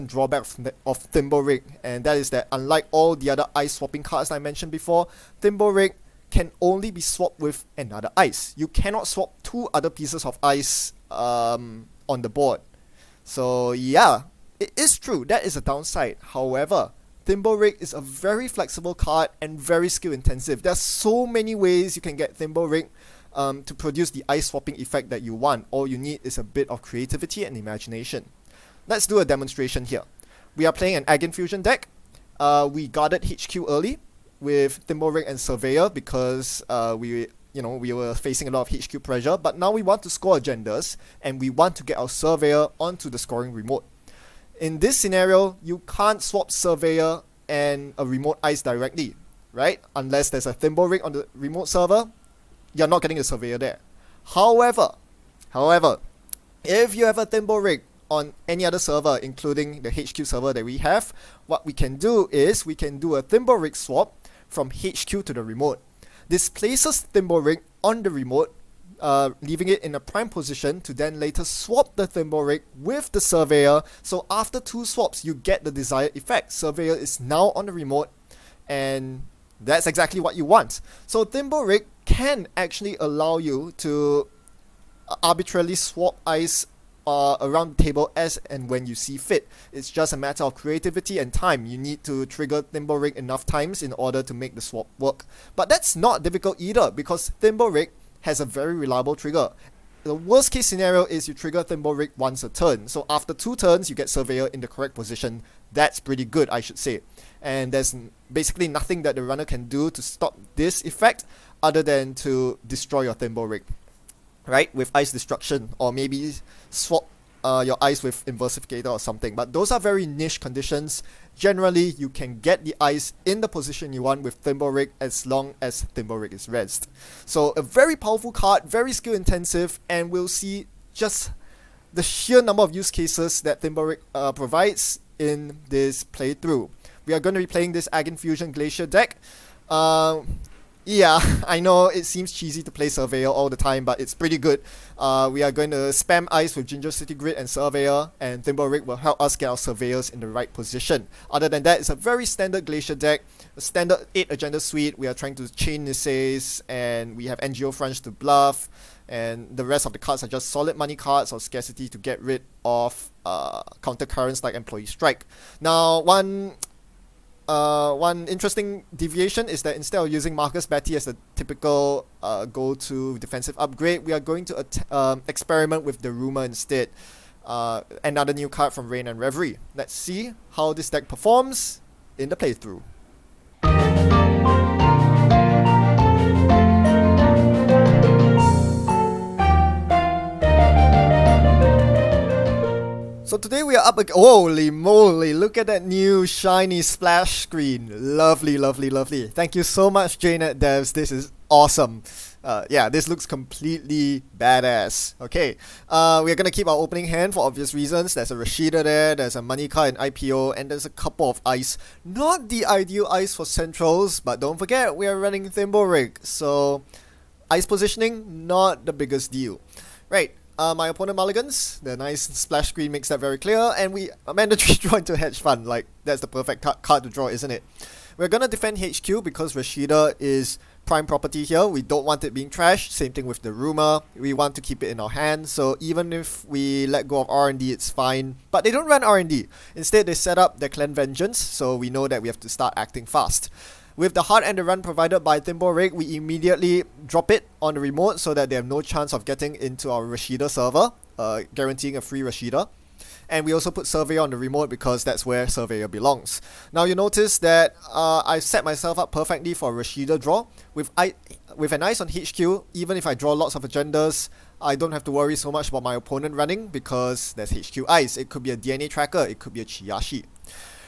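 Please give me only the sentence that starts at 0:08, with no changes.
You cannot swap two other pieces of ice um, on the board.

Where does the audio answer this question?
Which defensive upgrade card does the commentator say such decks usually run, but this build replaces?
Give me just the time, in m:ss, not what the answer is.
2:50.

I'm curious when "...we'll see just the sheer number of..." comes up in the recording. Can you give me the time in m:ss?
2:10.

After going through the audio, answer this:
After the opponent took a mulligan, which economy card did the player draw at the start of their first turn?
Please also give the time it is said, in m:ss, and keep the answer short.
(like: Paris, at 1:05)
Hedge Fund, at 3:45.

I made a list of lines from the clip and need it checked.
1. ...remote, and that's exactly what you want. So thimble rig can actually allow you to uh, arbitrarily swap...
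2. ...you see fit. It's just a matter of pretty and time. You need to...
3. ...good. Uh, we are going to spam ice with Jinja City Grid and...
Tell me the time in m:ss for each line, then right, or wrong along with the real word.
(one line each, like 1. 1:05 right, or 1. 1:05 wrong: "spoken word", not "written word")
1. 1:17 right
2. 1:28 wrong: "creativity", not "pretty"
3. 2:24 right.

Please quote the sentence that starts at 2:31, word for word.
Other than that, it's a very standard Glacier deck, a standard 8 agenda suite.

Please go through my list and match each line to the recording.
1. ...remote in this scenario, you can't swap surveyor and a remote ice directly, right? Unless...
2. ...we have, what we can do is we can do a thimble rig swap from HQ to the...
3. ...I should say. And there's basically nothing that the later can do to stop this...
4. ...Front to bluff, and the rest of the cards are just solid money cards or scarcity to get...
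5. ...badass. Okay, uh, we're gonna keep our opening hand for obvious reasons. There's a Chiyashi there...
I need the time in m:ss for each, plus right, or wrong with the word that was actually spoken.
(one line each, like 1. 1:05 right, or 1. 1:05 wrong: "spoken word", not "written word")
1. 0:43 right
2. 1:00 right
3. 1:46 wrong: "runner", not "later"
4. 2:37 right
5. 3:24 wrong: "Rashida", not "Chiyashi".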